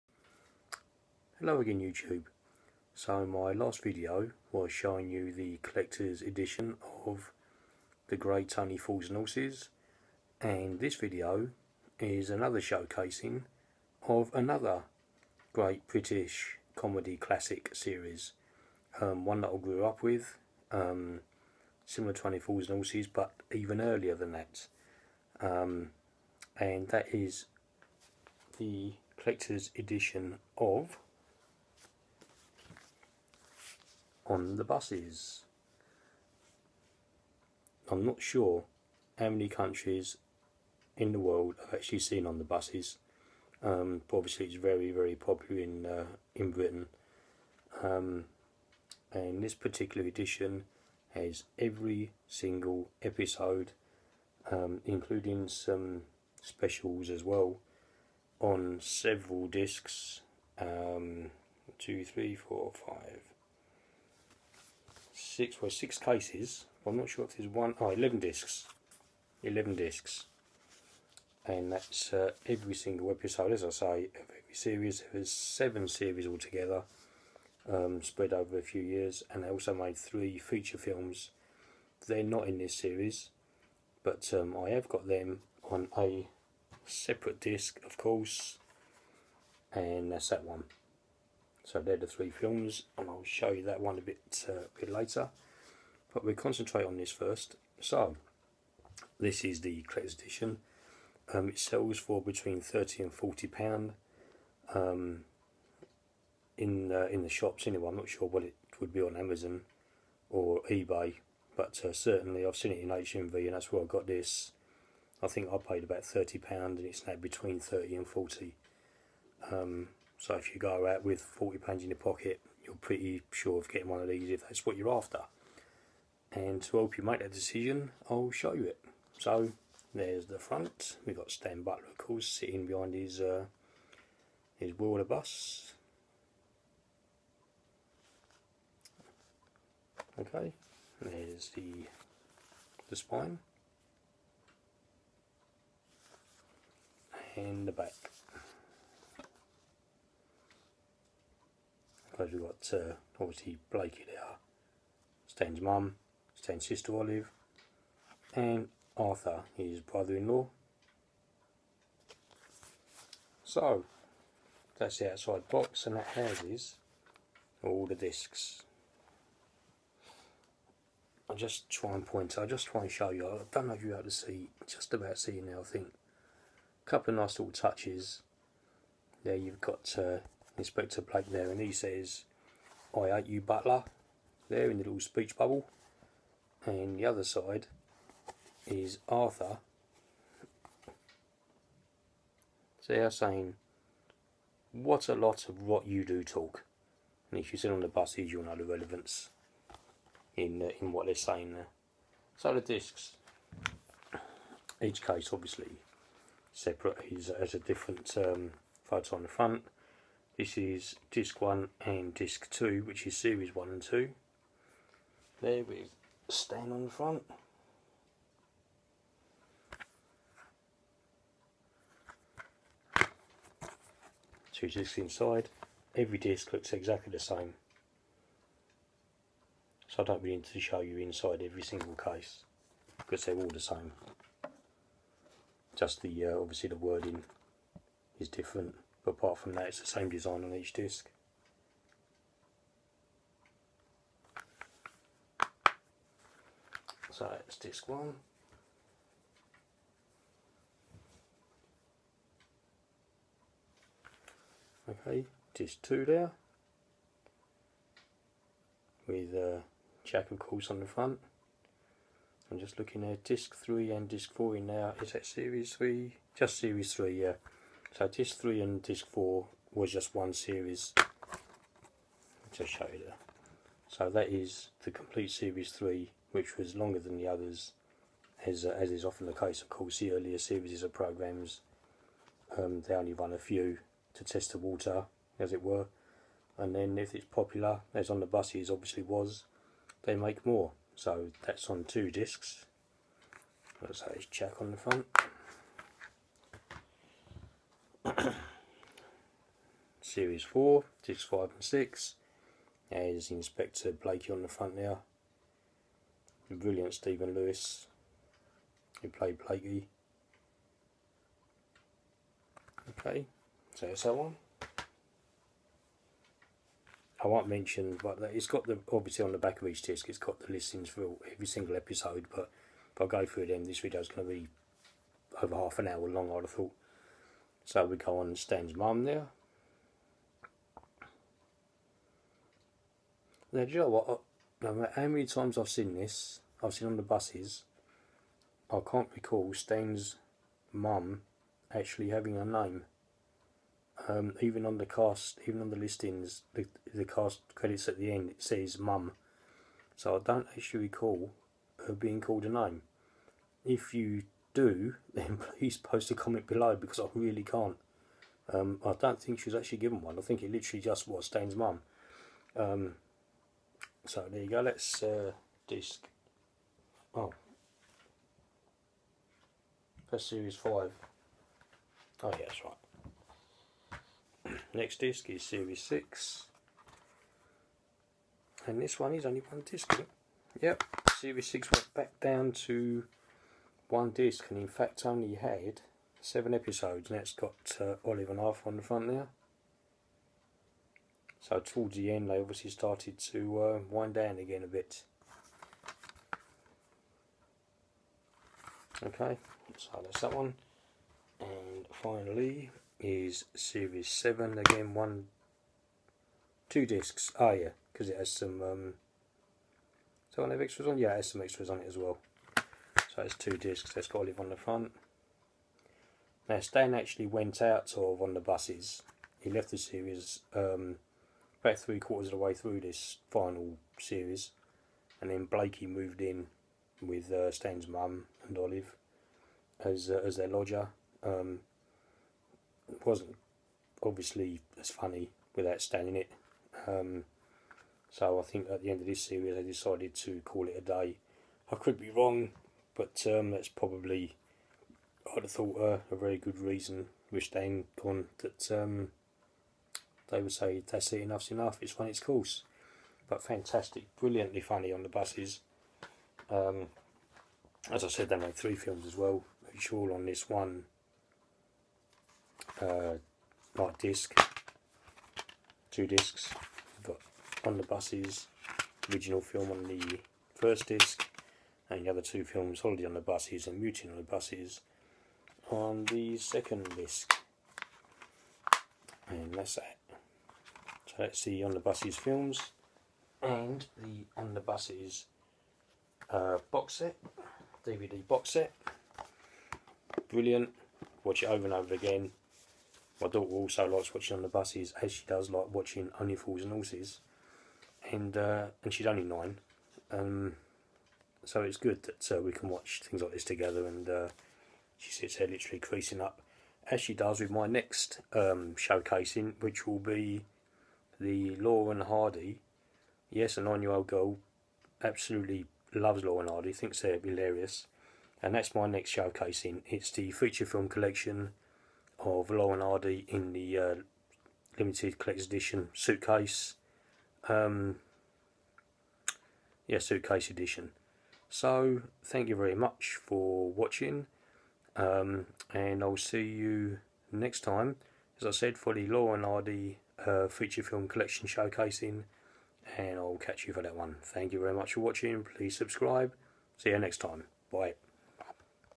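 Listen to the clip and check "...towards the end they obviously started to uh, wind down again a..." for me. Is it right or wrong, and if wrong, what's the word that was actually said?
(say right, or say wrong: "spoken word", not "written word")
right.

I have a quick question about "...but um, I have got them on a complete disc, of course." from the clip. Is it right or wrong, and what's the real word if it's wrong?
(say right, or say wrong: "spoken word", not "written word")
wrong: "separate", not "complete".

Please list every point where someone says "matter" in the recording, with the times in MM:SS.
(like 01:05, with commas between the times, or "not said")
05:34.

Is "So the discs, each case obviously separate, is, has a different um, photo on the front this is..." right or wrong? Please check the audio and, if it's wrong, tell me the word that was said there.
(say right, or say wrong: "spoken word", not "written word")
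right.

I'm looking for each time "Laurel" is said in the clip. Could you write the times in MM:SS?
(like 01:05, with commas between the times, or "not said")
08:31, 08:36, 08:42, 08:59.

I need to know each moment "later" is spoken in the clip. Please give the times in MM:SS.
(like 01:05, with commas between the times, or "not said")
01:34.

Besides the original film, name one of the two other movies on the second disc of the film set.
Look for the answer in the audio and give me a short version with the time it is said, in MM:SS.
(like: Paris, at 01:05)
Holiday on the Buses, at 07:52.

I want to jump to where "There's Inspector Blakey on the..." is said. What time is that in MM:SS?
05:02.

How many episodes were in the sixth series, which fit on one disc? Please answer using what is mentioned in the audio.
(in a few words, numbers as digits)
7.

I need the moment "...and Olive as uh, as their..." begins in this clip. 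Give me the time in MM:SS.
07:08.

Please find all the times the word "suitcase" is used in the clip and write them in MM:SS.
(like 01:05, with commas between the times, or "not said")
08:45, 08:49.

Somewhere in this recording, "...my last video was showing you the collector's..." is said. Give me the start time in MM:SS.
00:03.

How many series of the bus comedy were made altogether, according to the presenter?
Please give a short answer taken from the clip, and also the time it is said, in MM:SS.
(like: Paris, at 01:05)
7, at 01:15.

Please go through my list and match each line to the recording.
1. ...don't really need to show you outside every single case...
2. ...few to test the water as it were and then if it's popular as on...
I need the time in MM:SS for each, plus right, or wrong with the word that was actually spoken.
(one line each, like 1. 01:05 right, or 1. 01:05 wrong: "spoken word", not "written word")
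1. 03:50 wrong: "inside", not "outside"
2. 04:43 right.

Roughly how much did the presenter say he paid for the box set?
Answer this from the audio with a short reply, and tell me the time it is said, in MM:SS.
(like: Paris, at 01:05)
£30, at 01:56.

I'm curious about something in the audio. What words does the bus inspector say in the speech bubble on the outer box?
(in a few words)
I hate you, Butler.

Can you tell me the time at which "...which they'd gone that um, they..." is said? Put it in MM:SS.
07:27.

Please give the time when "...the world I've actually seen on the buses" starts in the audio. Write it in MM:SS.
00:41.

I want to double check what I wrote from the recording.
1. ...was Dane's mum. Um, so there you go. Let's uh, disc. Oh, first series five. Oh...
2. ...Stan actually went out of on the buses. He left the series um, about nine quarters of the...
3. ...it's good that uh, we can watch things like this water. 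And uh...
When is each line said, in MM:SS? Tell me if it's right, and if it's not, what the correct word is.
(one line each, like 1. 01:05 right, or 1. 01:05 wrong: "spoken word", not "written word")
1. 06:01 right
2. 06:56 wrong: "three", not "nine"
3. 08:21 wrong: "together", not "water".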